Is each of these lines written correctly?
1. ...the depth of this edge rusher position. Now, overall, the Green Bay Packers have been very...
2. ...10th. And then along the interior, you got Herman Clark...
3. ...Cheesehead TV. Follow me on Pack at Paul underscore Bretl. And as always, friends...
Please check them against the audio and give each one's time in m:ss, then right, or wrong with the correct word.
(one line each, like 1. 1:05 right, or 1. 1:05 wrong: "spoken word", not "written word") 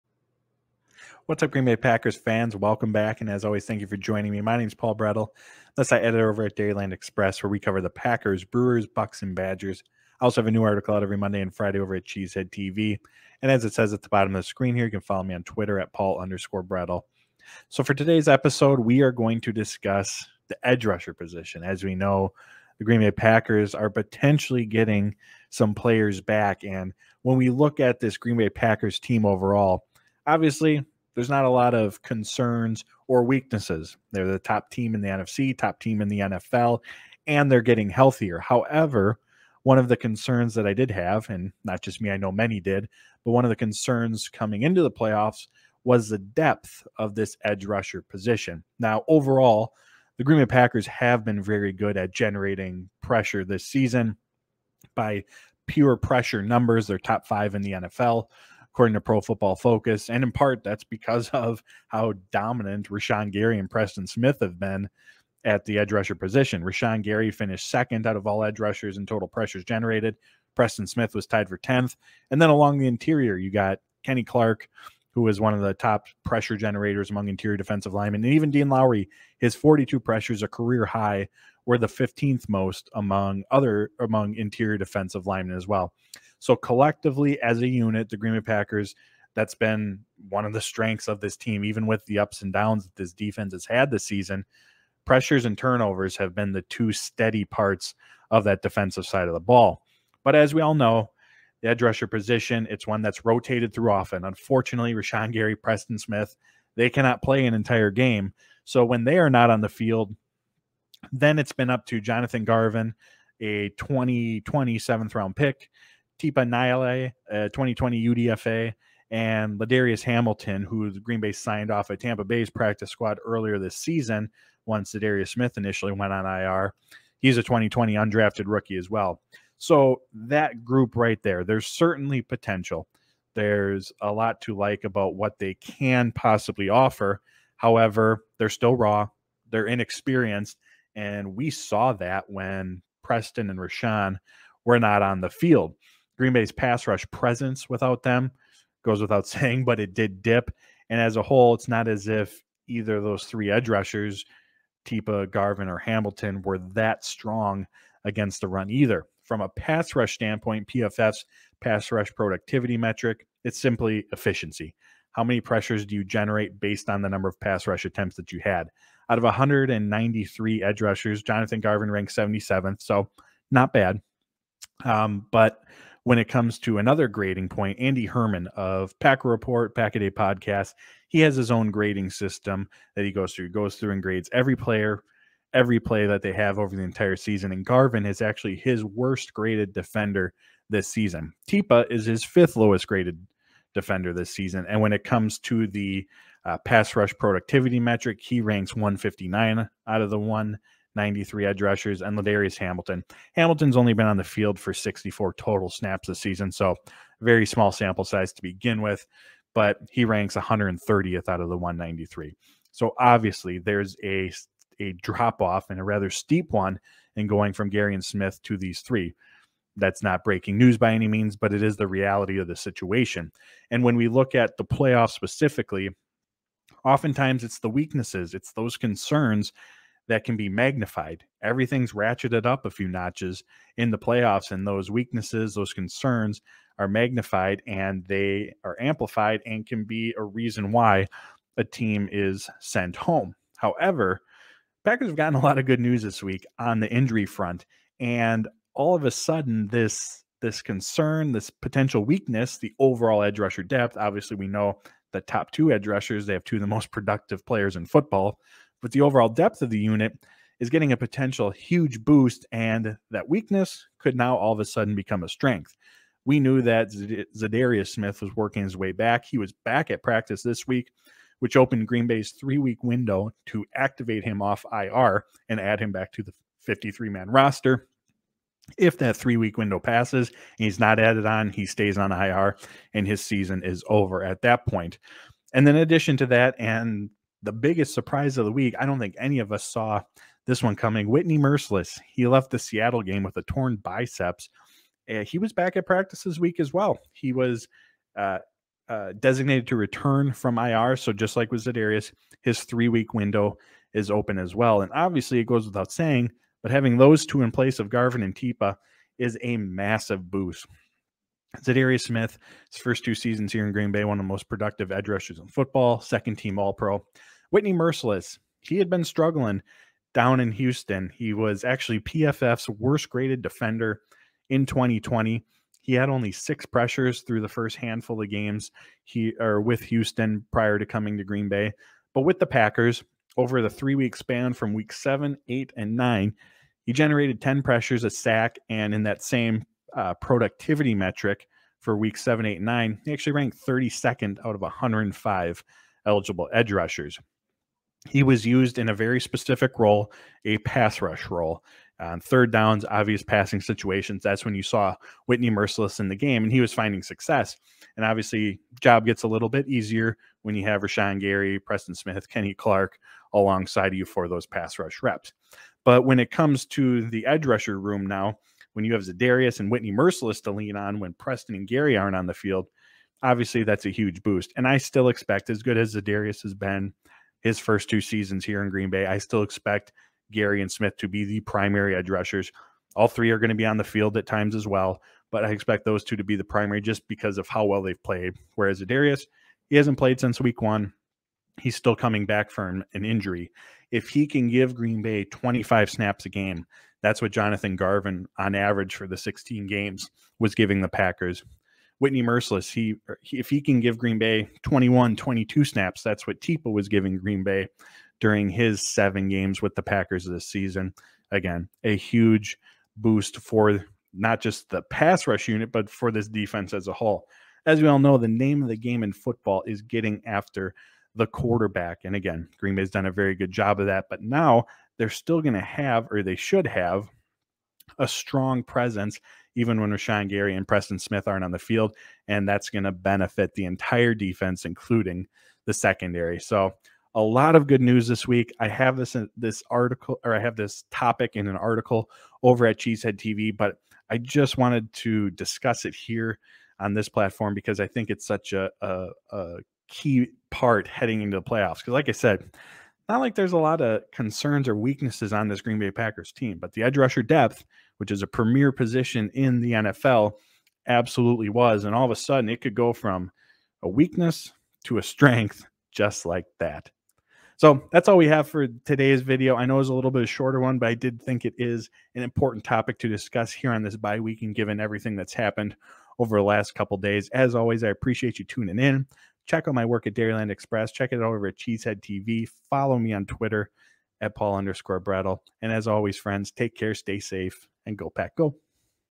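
1. 0:46 right
2. 1:11 wrong: "Kenny", not "Herman"
3. 8:01 wrong: "Twitter", not "Pack".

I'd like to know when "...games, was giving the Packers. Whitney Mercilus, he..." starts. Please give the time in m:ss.
6:39.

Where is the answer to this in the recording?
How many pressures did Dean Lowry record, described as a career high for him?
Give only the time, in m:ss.
1:19.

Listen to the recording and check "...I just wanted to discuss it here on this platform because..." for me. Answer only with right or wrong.
right.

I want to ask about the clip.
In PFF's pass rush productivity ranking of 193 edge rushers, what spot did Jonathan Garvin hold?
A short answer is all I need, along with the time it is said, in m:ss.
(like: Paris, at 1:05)
77th, at 2:52.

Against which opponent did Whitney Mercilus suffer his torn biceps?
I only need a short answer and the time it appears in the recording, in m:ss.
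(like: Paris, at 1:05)
Seattle, at 4:52.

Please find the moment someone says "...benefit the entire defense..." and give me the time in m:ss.
7:12.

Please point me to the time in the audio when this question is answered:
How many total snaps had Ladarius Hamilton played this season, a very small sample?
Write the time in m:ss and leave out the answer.
3:24.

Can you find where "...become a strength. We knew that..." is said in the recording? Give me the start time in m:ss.
4:24.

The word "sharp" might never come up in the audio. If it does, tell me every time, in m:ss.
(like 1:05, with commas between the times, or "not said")
not said.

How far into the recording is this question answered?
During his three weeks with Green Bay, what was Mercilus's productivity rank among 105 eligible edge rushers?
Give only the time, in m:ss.
5:43.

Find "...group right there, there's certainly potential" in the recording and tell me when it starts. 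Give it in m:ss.
2:10.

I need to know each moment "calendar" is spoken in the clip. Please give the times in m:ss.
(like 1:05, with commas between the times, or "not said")
not said.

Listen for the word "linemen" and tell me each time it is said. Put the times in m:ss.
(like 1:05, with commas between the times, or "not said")
1:17, 1:25.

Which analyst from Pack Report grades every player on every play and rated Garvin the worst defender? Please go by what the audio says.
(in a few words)
Andy Herman.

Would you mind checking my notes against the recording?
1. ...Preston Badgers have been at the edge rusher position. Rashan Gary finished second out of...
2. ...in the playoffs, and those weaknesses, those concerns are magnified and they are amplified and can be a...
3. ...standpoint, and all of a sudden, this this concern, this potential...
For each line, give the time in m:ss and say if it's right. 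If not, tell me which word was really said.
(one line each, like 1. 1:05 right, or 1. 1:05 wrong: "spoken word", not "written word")
1. 1:03 wrong: "Smith", not "Badgers"
2. 3:53 right
3. 4:07 wrong: "front", not "standpoint".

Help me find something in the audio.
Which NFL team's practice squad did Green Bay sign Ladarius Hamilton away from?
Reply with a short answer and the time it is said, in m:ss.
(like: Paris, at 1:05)
Tampa Bay, at 2:01.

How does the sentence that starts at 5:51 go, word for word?
On third downs, obvious passing situations.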